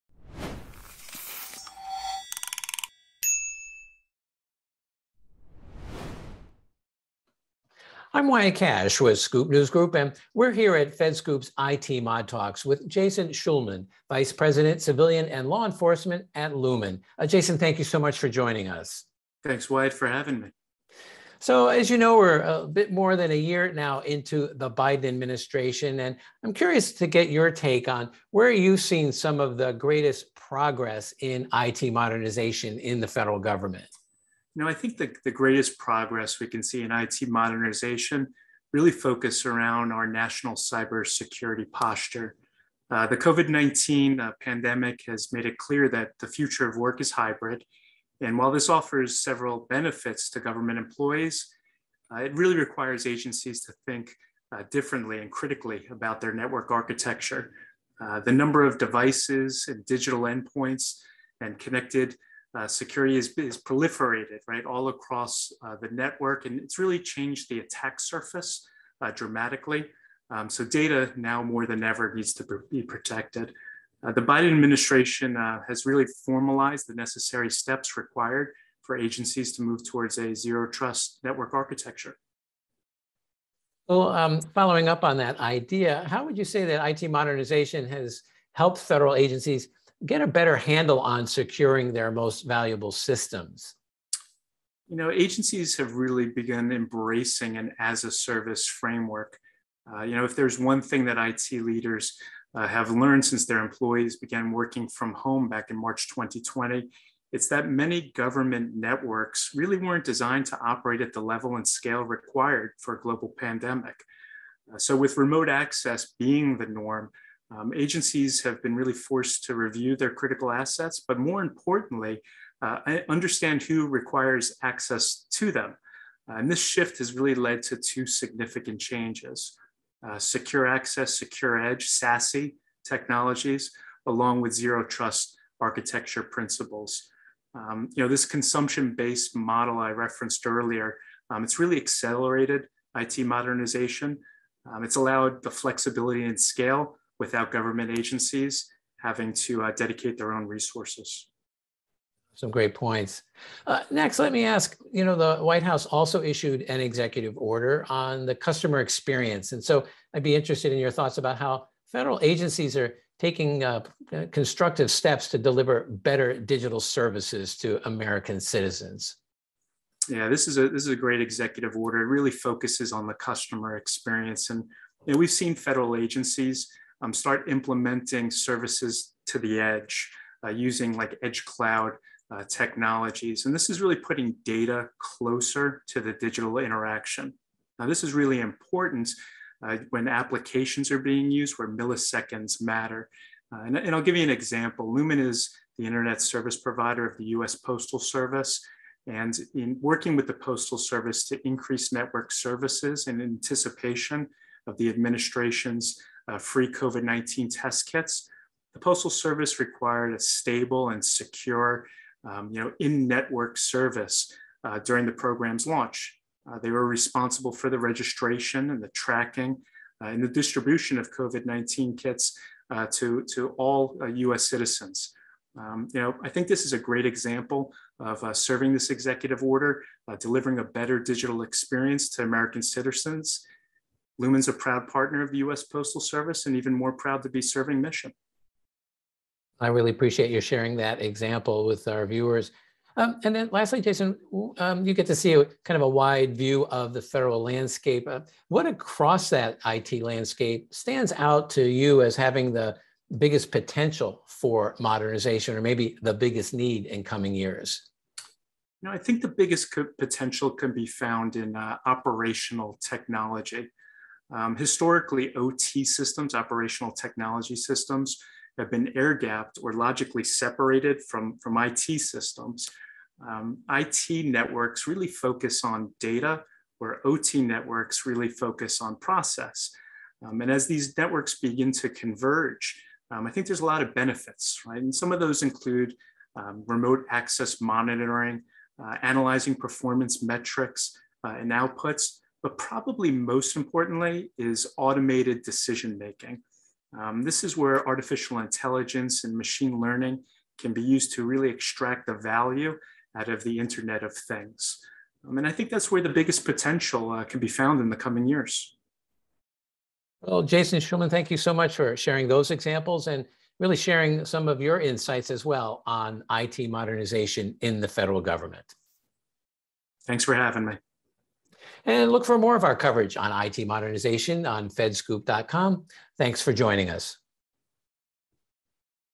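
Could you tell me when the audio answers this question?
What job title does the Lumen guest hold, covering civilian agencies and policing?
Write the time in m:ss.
0:14.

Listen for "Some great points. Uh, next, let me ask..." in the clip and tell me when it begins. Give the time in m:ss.
2:32.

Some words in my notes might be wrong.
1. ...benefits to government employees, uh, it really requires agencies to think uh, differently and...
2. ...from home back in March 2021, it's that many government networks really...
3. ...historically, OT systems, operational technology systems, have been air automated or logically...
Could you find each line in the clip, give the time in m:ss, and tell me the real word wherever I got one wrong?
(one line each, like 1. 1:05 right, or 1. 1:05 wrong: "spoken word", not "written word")
1. 0:49 right
2. 1:44 wrong: "2020", not "2021"
3. 4:24 wrong: "gapped", not "automated".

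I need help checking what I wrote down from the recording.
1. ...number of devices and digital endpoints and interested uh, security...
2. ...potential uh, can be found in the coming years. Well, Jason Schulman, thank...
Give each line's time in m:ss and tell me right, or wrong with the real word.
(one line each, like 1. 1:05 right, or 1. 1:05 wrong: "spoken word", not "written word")
1. 0:58 wrong: "connected", not "interested"
2. 5:06 right.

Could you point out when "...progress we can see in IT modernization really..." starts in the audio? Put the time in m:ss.
0:35.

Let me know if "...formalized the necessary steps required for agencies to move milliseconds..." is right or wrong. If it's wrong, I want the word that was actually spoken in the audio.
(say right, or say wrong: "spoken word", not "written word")
wrong: "towards", not "milliseconds".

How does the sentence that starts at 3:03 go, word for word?
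And this is really putting data closer to the digital interaction.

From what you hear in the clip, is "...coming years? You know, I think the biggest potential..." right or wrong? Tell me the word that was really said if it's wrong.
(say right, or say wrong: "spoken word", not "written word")
right.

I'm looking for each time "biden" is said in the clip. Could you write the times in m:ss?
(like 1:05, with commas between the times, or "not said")
0:24, 1:14.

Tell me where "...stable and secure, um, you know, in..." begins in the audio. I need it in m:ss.
3:30.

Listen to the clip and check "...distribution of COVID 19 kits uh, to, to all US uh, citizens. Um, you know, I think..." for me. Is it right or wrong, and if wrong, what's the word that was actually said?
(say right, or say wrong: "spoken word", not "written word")
right.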